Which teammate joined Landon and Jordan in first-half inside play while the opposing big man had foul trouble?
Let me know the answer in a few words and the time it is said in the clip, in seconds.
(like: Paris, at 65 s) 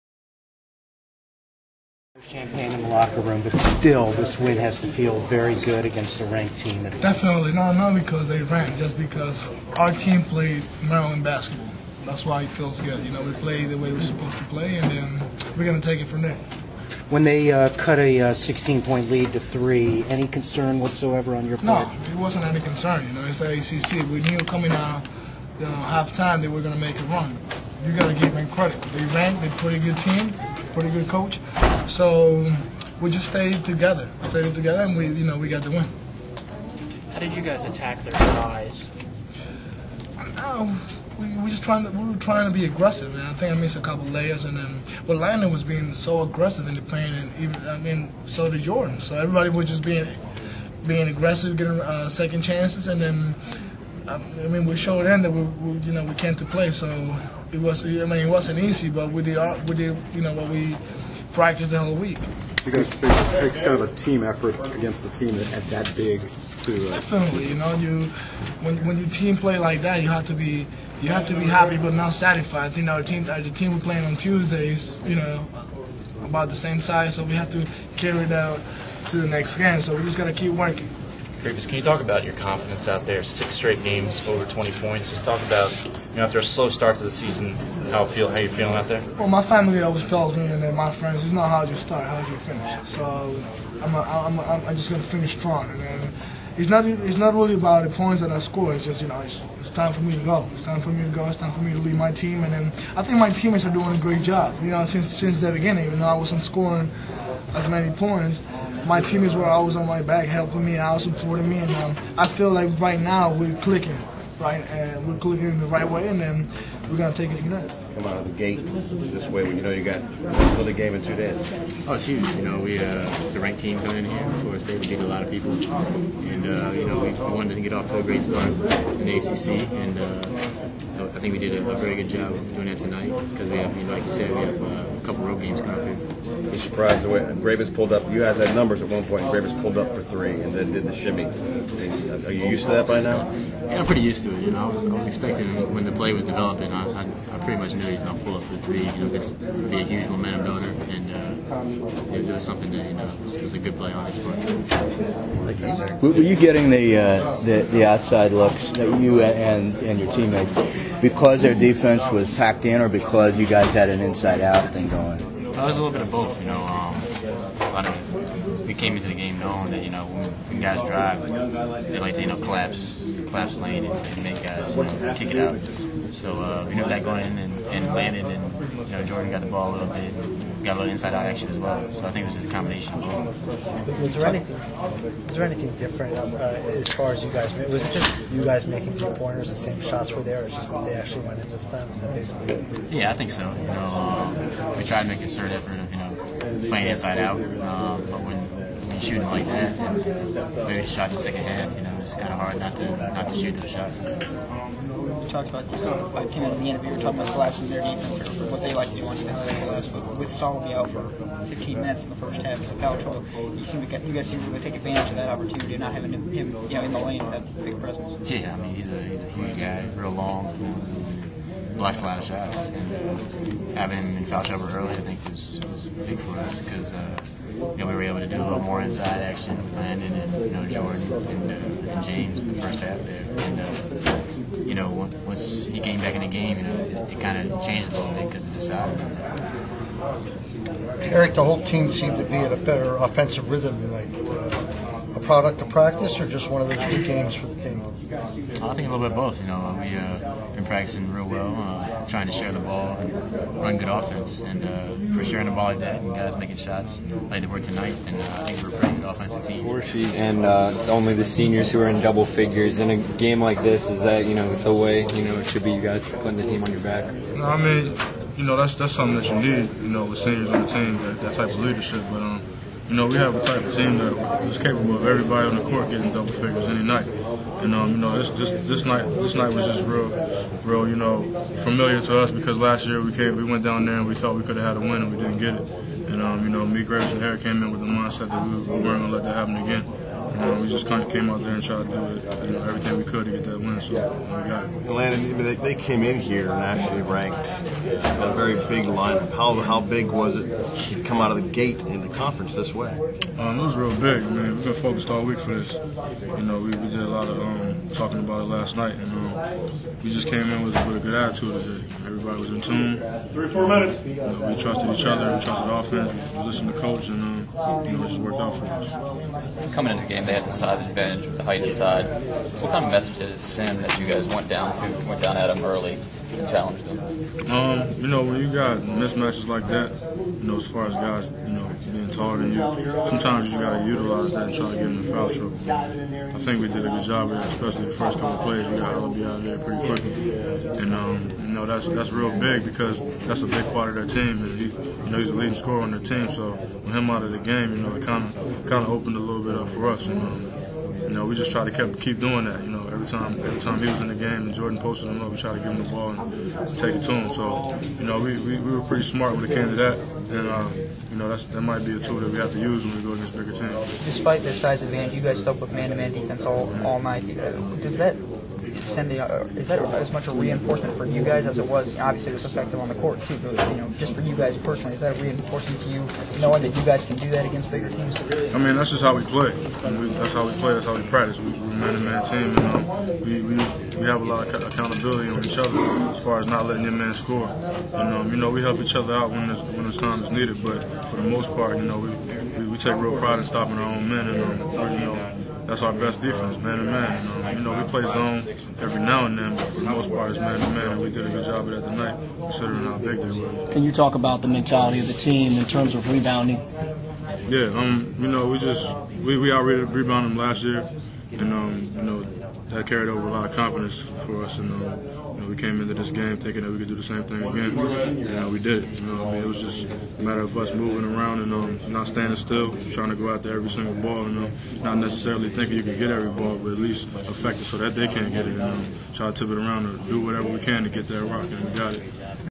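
James, at 232 s.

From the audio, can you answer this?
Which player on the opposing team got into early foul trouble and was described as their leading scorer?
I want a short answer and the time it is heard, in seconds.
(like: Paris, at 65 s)
Alabi, at 338 s.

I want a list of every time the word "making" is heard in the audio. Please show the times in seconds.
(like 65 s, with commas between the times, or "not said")
188 s, 256 s.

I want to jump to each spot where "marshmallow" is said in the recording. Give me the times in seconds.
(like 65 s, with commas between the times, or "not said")
not said.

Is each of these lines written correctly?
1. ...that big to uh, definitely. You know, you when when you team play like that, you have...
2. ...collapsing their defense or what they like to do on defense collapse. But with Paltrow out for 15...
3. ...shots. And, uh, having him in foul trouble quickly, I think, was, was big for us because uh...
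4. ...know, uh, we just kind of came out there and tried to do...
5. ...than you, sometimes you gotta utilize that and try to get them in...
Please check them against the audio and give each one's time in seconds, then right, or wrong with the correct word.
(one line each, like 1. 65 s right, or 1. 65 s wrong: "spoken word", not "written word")
1. 65 s right
2. 207 s wrong: "Solomon", not "Paltrow"
3. 222 s wrong: "early", not "quickly"
4. 290 s right
5. 332 s right.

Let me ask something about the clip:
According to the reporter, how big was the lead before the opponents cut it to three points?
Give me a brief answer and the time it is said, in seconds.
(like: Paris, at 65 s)
16 points, at 18 s.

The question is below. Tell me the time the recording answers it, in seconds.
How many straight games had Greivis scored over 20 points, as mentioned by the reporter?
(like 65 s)
83 s.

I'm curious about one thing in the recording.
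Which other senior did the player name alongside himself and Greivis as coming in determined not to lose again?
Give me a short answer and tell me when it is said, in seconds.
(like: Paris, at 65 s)
Harry, at 287 s.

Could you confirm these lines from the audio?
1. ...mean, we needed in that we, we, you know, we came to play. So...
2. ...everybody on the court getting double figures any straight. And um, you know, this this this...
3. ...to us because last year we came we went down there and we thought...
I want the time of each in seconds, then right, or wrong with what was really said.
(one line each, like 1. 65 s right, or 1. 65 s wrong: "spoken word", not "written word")
1. 54 s wrong: "showed", not "needed"
2. 275 s wrong: "night", not "straight"
3. 282 s right.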